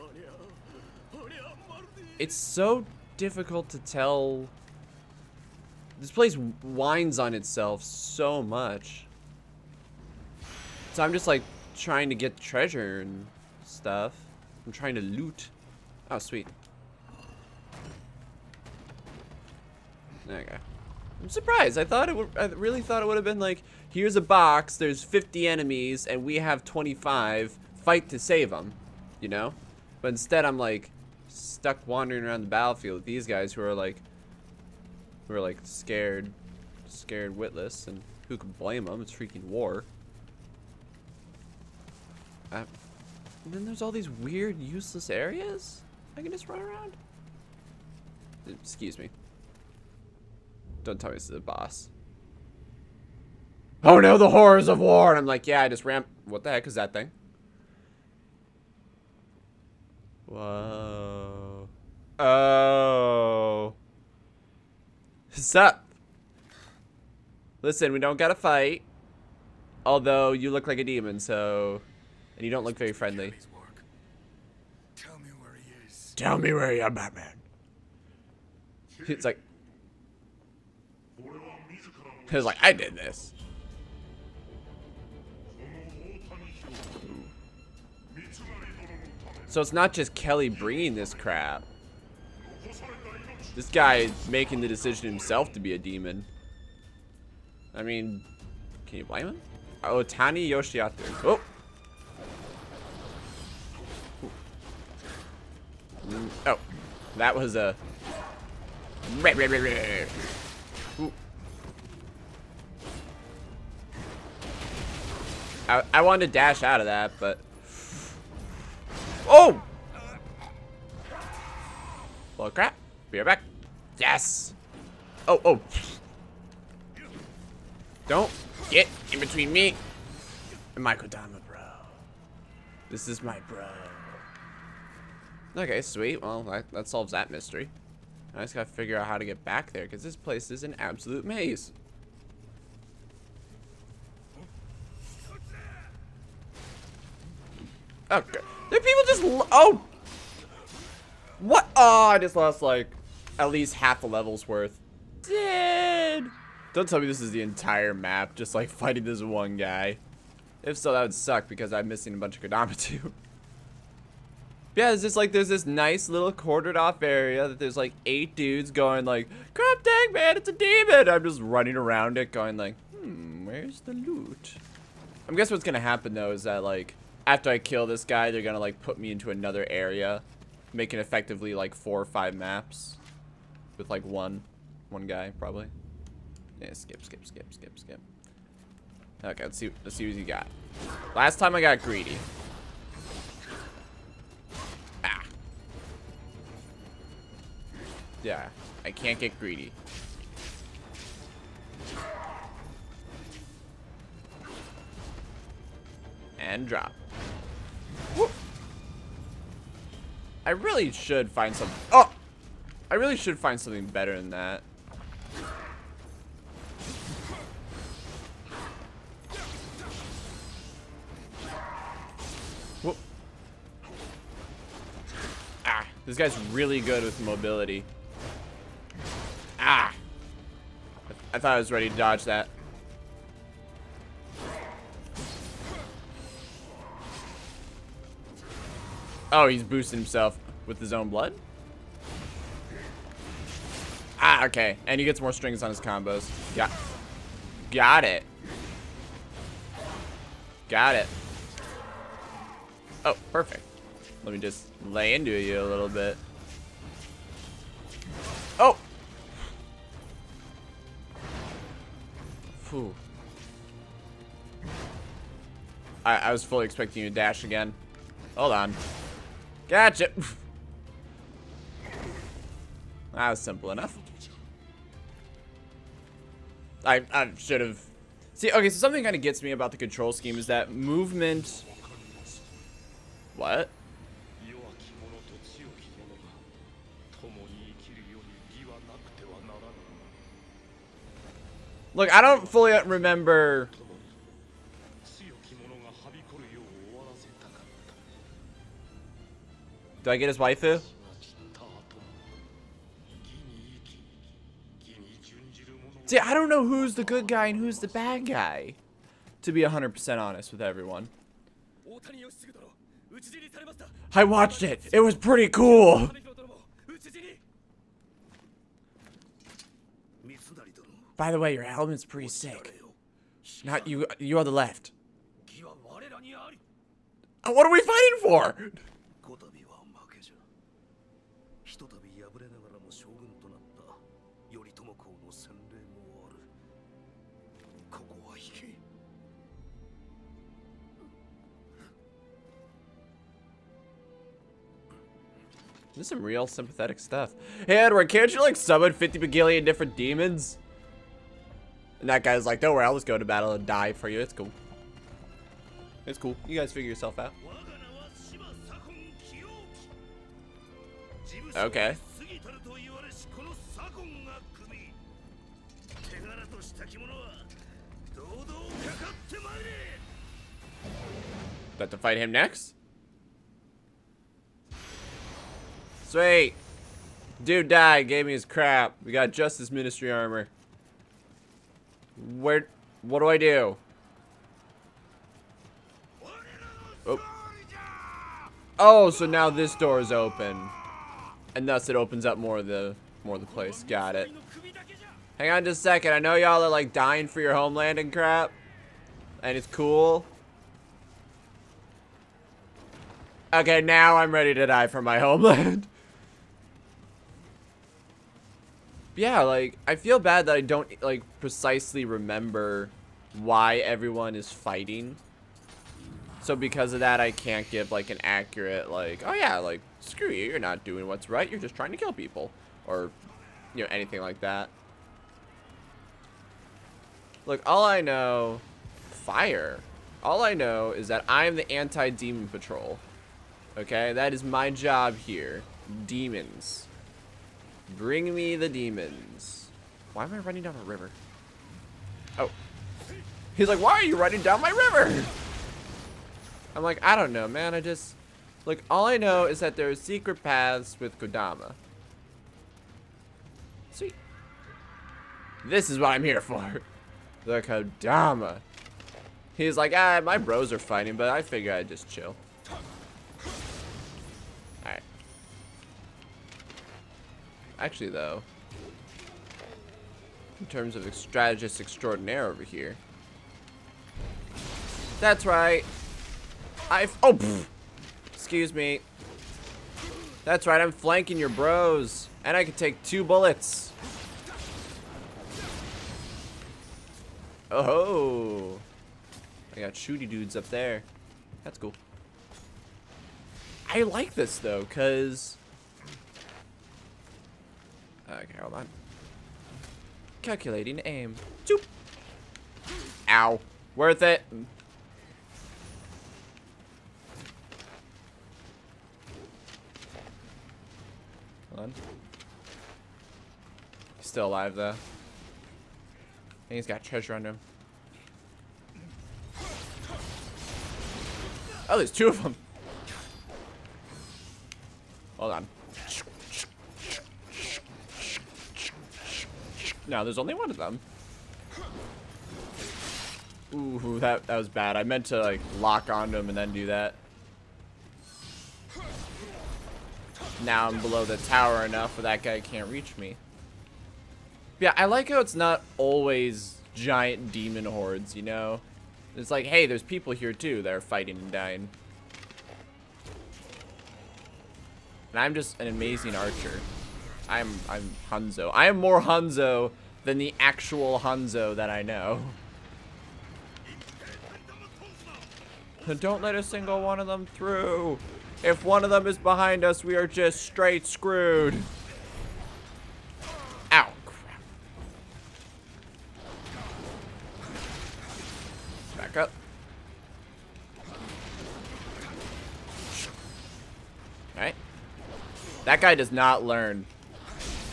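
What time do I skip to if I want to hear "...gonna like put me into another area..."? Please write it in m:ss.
2:58.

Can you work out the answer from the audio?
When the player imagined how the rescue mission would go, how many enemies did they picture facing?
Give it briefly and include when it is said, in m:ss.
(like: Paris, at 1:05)
50, at 0:25.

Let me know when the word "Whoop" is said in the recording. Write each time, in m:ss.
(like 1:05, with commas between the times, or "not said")
3:28, 3:42.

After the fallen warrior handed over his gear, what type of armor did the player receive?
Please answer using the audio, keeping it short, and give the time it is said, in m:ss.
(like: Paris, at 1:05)
Justice Ministry armor, at 6:19.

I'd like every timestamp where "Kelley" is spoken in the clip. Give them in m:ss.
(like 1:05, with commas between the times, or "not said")
1:30.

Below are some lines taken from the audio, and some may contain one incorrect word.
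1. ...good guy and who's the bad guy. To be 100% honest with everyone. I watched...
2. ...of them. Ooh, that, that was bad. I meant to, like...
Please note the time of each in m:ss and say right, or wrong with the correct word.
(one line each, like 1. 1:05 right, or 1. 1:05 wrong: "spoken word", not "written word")
1. 5:07 right
2. 8:50 right.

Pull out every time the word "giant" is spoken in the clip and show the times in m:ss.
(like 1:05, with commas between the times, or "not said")
9:06.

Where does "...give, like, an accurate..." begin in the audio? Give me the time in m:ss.
6:57.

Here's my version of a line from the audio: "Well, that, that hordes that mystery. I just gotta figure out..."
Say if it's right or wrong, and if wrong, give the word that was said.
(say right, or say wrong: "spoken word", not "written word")
wrong: "solves", not "hordes".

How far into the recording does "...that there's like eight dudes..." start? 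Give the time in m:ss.
2:47.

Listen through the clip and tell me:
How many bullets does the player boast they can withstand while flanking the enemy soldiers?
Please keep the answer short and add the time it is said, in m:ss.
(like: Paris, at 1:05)
2, at 8:03.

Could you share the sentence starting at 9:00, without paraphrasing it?
Now I'm below the tower enough where that guy can't reach me.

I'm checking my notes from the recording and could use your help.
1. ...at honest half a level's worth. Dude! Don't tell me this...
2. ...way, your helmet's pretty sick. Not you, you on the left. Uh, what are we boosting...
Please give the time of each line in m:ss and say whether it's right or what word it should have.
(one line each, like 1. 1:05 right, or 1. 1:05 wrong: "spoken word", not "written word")
1. 2:33 wrong: "least", not "honest"
2. 5:21 wrong: "fighting", not "boosting".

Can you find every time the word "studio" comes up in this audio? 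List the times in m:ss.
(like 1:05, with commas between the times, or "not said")
not said.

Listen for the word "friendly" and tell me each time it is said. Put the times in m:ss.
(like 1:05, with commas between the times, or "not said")
1:12.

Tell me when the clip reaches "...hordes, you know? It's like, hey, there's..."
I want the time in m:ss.
9:07.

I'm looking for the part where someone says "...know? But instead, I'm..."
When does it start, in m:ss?
0:29.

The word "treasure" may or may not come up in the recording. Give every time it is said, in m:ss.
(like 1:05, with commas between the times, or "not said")
0:12, 8:37.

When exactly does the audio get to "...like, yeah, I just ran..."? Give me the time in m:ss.
0:55.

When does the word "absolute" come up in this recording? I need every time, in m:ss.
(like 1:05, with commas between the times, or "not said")
2:20.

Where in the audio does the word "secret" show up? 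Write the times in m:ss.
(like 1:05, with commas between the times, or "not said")
7:29.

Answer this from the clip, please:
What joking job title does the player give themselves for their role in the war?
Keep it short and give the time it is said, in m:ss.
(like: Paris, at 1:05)
anti-demon patrol, at 7:11.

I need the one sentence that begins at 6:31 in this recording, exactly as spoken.
And thus it opens up more of the more of the place.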